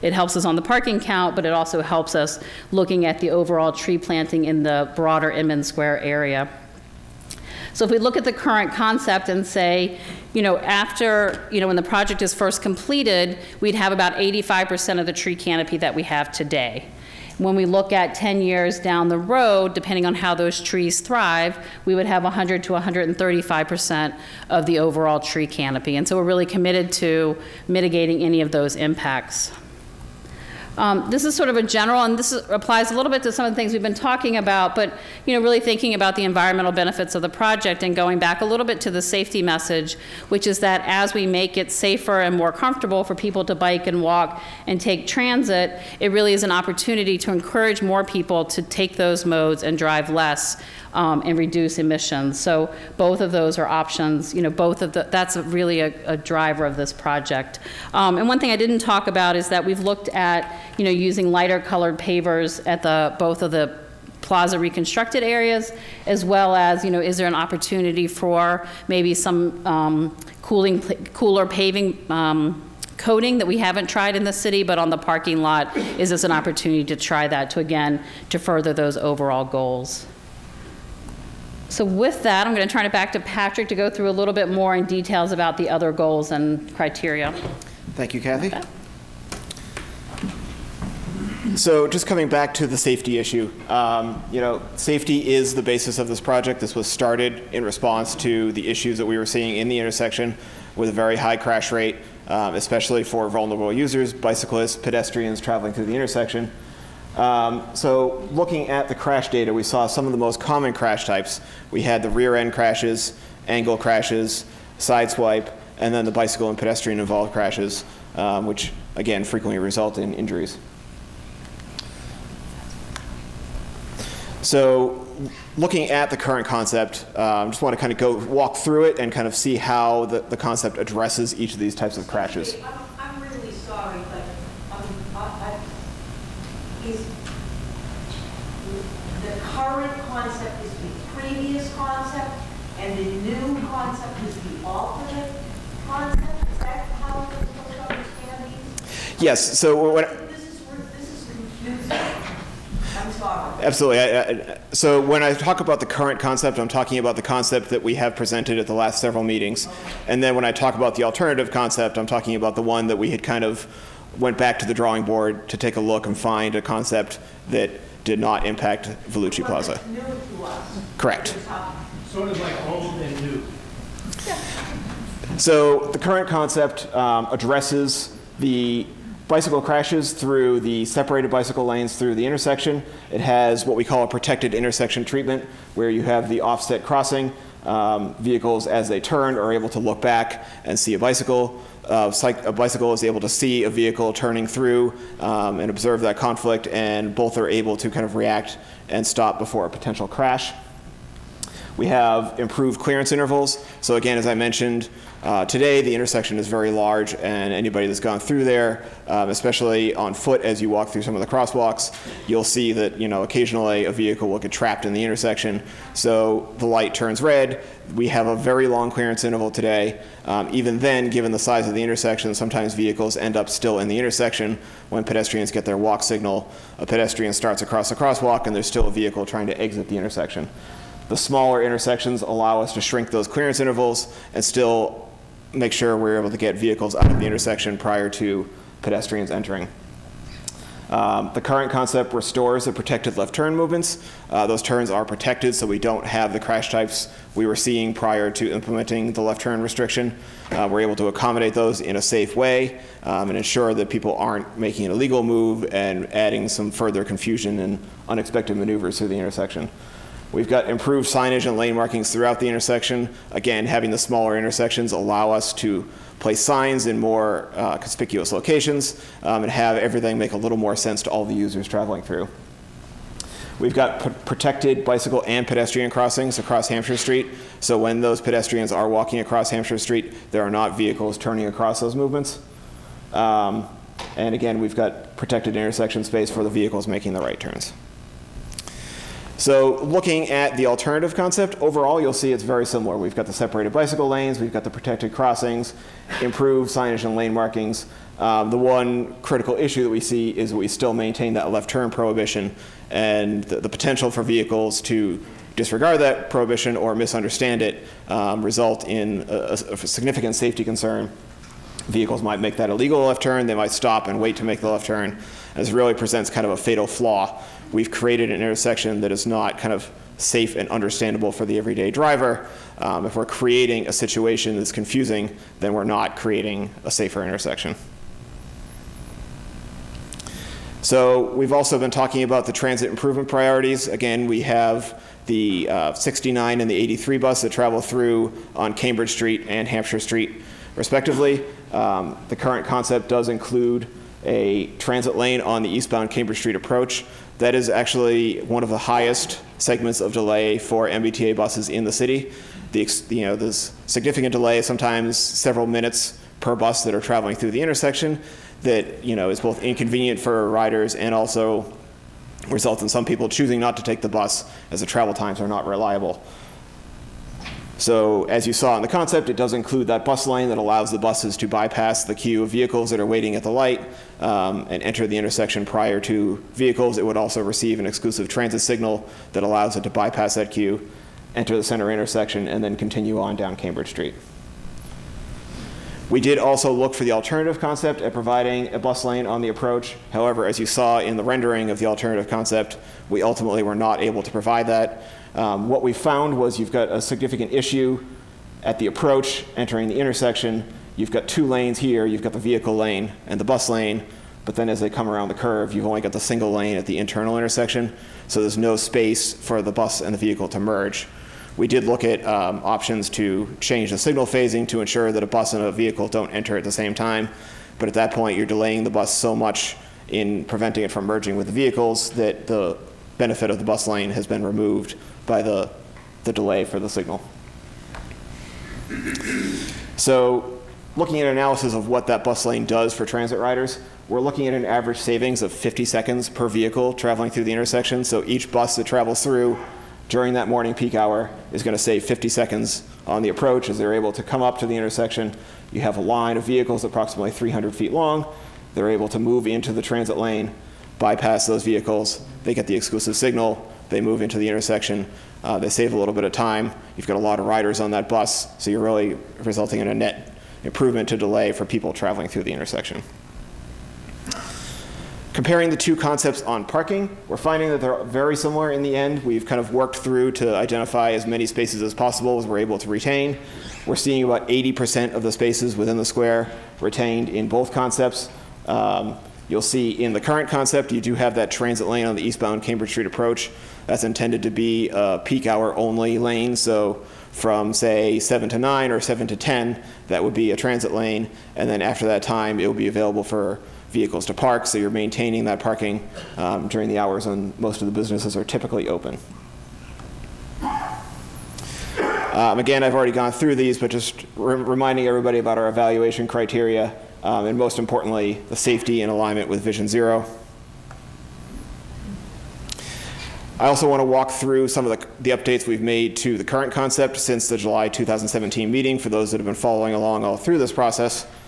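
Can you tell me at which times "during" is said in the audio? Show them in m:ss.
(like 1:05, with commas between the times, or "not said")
7:20, 8:16.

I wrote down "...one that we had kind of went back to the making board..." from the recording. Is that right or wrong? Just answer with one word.
wrong.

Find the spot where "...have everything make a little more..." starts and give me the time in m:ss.
4:29.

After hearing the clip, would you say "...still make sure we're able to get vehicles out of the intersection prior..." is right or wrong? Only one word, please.
right.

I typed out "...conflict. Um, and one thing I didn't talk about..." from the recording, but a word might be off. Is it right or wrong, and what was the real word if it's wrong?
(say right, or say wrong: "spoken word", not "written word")
wrong: "project", not "conflict".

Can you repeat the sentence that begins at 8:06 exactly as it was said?
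So from say 7 to 9 or 7 to 10, that would be a transit lane.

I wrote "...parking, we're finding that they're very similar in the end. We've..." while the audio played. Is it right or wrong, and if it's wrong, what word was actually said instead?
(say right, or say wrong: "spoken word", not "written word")
right.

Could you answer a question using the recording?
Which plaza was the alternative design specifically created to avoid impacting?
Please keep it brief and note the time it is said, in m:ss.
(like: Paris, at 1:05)
Vellucci Plaza, at 2:49.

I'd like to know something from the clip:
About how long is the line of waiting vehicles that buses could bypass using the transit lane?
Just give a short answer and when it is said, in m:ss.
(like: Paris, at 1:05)
300 feet, at 7:27.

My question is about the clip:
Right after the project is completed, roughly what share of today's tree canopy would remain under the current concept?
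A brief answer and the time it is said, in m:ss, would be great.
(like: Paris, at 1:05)
85%, at 0:14.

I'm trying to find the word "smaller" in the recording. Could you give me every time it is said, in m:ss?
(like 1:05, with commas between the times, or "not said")
3:51, 4:23.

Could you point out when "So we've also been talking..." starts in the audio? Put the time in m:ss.
5:30.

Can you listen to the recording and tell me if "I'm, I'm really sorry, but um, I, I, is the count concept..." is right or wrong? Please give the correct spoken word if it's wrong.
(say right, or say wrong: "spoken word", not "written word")
wrong: "current", not "count".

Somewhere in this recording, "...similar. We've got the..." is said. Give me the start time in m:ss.
4:52.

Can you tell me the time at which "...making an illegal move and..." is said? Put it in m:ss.
4:14.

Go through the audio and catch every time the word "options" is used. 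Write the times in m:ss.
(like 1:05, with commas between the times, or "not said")
0:53, 6:52.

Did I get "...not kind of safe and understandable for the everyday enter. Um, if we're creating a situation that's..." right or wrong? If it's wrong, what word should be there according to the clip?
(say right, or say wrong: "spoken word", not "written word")
wrong: "driver", not "enter".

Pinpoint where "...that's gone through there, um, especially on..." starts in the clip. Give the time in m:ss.
3:27.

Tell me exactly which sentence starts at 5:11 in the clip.
Vehicles might make that illegal left turn, they might stop and wait to make the left turn.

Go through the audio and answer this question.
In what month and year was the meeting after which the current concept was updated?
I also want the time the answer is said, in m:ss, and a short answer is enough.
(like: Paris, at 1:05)
July 2017, at 8:37.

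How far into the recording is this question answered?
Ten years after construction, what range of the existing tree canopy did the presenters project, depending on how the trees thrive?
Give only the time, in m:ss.
0:22.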